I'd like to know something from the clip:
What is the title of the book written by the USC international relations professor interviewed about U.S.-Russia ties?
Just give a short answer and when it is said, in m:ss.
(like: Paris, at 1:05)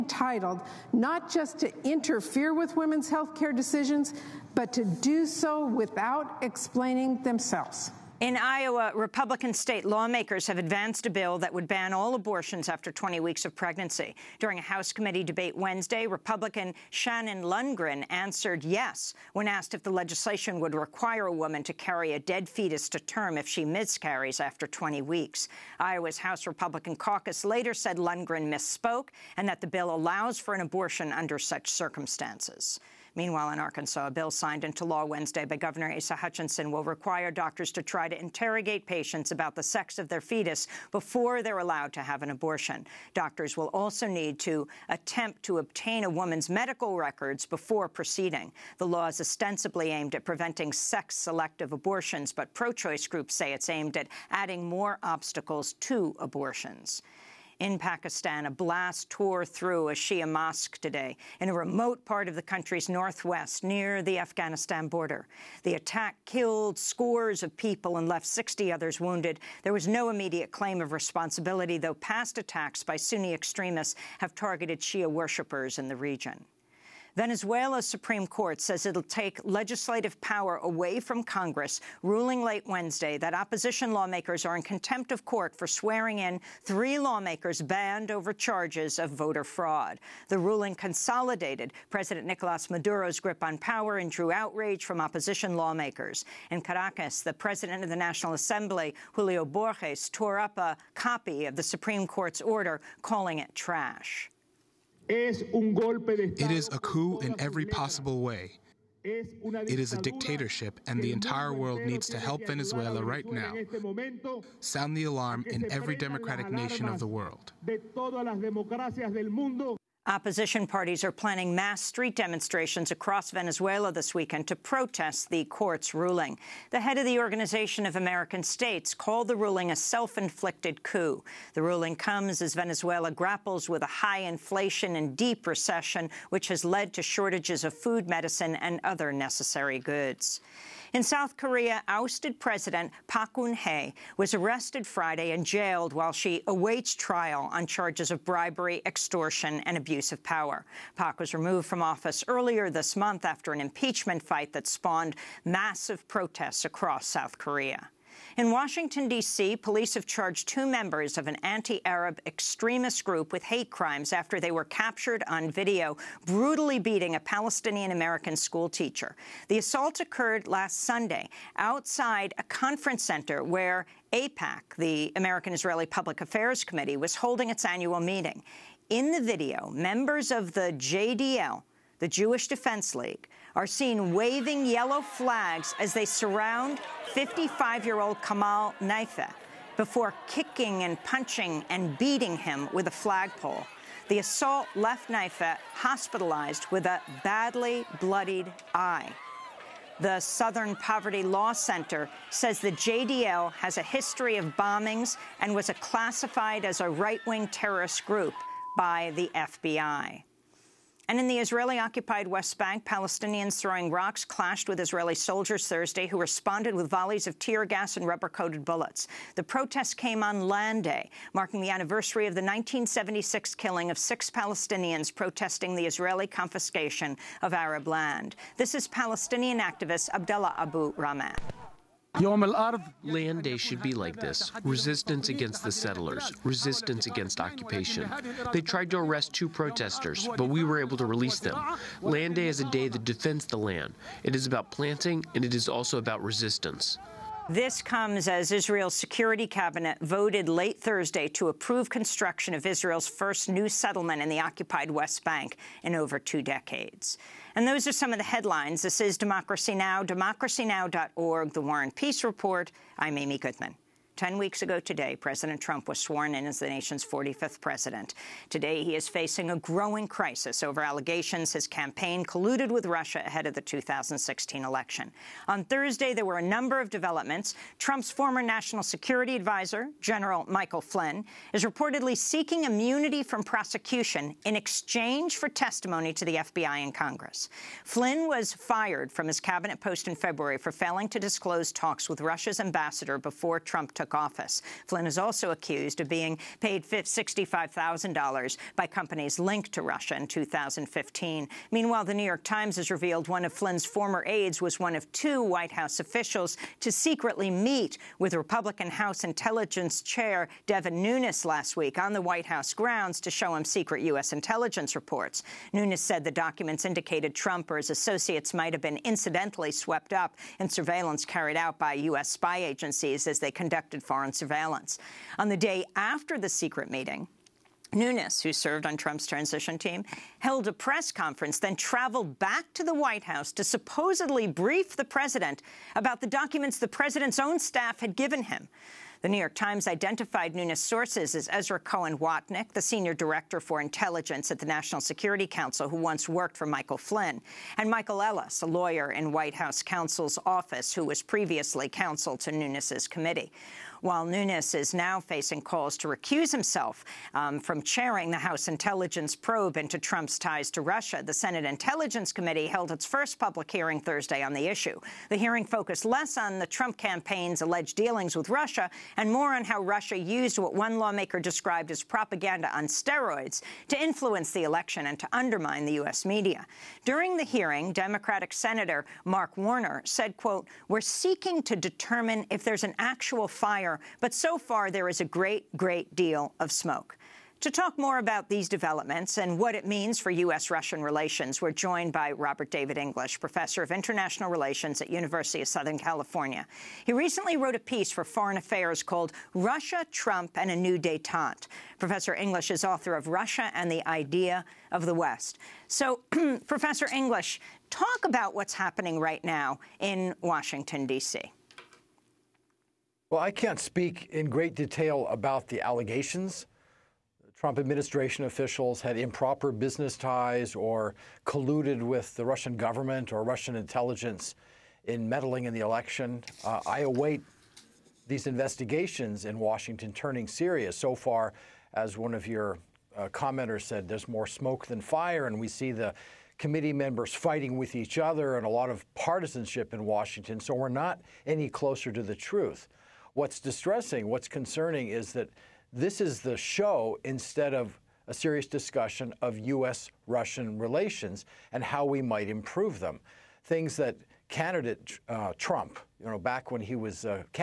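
Russia and the Idea of the West, at 6:43.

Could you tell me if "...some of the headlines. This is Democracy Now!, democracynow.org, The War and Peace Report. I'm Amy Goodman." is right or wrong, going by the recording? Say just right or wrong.
right.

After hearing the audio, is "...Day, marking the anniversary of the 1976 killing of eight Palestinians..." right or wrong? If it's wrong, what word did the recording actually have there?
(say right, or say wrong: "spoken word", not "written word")
wrong: "six", not "eight".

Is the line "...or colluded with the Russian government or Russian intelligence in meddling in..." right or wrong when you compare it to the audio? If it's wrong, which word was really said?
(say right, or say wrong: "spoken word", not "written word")
right.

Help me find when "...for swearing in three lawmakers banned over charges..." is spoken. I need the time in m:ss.
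1:25.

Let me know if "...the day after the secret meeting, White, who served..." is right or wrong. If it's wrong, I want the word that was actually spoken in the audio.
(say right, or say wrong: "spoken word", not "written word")
wrong: "Nunes", not "White".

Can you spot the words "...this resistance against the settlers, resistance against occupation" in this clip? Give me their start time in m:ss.
3:54.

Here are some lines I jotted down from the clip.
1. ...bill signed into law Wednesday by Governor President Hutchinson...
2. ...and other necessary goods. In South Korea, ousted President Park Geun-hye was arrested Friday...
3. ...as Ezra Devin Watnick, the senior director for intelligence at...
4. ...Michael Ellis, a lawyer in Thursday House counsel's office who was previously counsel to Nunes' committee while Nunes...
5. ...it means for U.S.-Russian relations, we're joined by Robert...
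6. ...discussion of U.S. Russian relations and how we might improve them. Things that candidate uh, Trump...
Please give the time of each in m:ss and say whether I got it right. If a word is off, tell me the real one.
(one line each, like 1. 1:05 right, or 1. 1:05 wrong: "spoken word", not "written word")
1. 0:34 wrong: "Asa", not "President"
2. 2:18 right
3. 5:41 wrong: "Cohen", not "Devin"
4. 5:47 wrong: "White", not "Thursday"
5. 6:29 right
6. 7:28 right.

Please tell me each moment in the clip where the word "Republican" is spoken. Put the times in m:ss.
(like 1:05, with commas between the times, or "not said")
0:08, 0:16, 0:26, 5:08.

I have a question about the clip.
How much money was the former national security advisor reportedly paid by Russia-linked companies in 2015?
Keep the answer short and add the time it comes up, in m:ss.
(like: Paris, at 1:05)
$65,000, at 4:56.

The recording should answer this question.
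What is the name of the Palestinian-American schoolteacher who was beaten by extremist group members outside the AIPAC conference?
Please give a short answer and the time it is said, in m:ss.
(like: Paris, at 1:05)
Kamal Nayfeh, at 3:08.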